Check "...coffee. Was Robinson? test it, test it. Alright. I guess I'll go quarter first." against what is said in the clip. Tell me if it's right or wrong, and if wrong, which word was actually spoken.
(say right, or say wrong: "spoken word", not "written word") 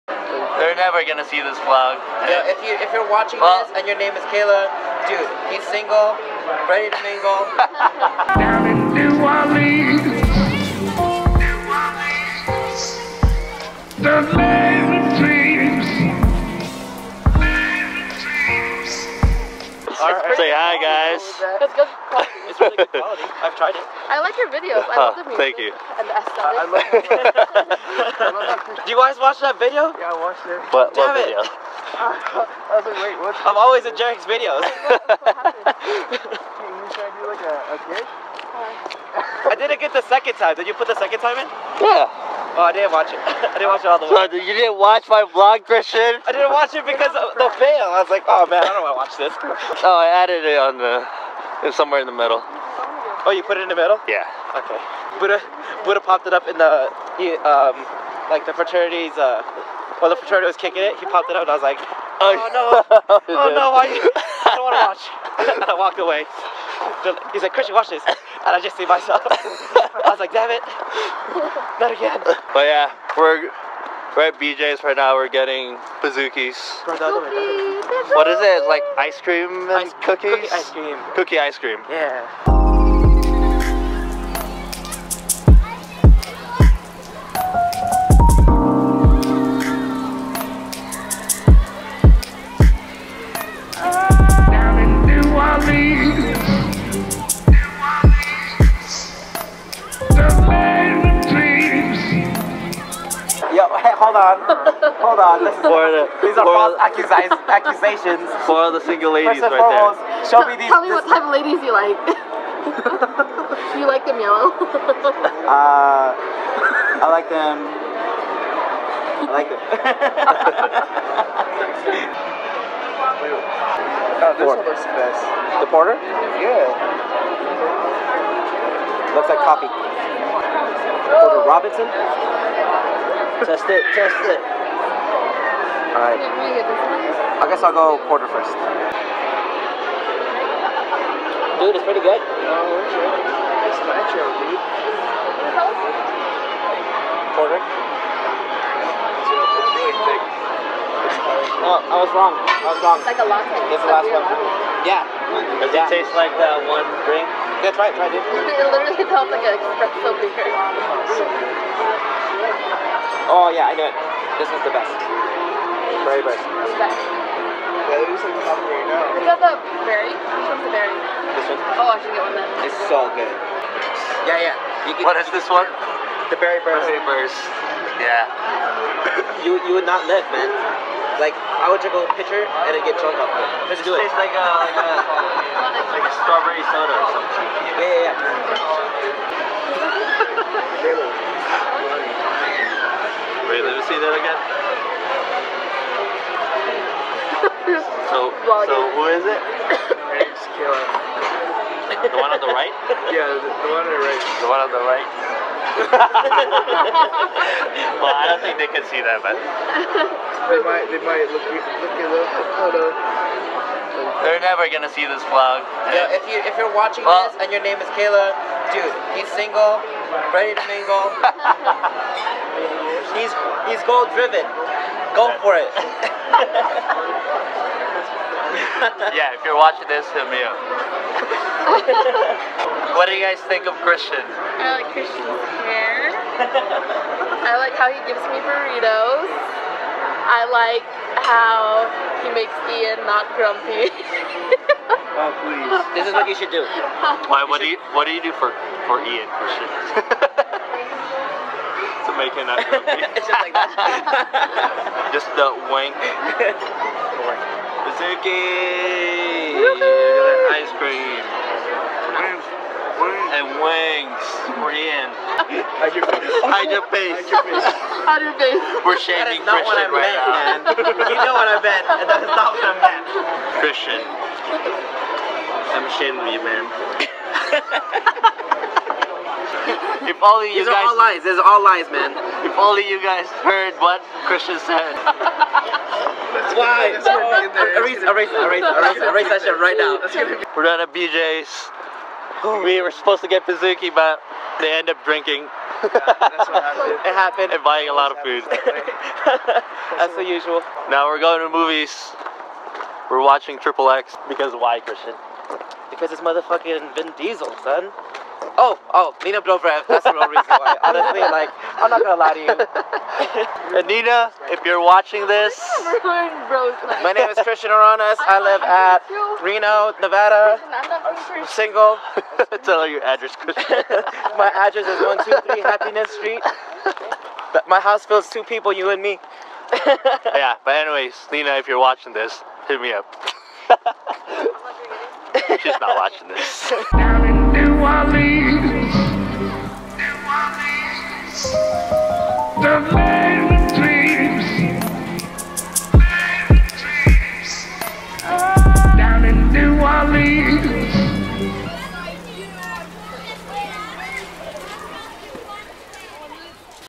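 right.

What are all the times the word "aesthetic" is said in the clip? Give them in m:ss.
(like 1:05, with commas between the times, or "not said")
0:26.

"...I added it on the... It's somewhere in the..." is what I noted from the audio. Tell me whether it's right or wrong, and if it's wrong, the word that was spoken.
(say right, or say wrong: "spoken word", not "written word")
right.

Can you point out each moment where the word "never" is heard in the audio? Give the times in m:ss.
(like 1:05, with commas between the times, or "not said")
0:00, 3:34.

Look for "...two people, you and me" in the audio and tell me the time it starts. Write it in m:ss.
5:28.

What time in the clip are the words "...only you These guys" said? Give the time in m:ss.
4:40.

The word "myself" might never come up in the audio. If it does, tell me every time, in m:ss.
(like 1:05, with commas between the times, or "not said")
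1:08.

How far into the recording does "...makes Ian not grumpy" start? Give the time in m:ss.
4:02.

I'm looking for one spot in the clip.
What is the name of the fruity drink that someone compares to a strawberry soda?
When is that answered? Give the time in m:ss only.
2:56.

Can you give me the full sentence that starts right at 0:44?
So, you didn't watch my vlog, Christian?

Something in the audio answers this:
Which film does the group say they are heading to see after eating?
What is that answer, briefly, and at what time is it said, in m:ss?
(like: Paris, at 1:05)
Triple X, at 5:03.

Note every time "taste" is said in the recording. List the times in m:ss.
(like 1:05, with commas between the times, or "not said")
2:36, 3:03.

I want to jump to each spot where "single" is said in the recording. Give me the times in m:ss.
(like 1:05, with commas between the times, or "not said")
0:05, 1:48, 3:39, 5:21.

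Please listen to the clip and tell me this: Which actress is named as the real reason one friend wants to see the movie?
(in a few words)
Nina Dobrev.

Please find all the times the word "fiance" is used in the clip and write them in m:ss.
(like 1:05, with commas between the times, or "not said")
not said.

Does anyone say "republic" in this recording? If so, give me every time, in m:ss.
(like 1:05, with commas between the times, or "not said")
not said.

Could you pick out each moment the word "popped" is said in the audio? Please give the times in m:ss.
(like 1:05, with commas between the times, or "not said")
0:56, 1:01.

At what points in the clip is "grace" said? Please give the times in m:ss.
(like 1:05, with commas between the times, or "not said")
not said.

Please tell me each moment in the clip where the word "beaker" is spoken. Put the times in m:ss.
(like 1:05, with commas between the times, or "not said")
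2:40.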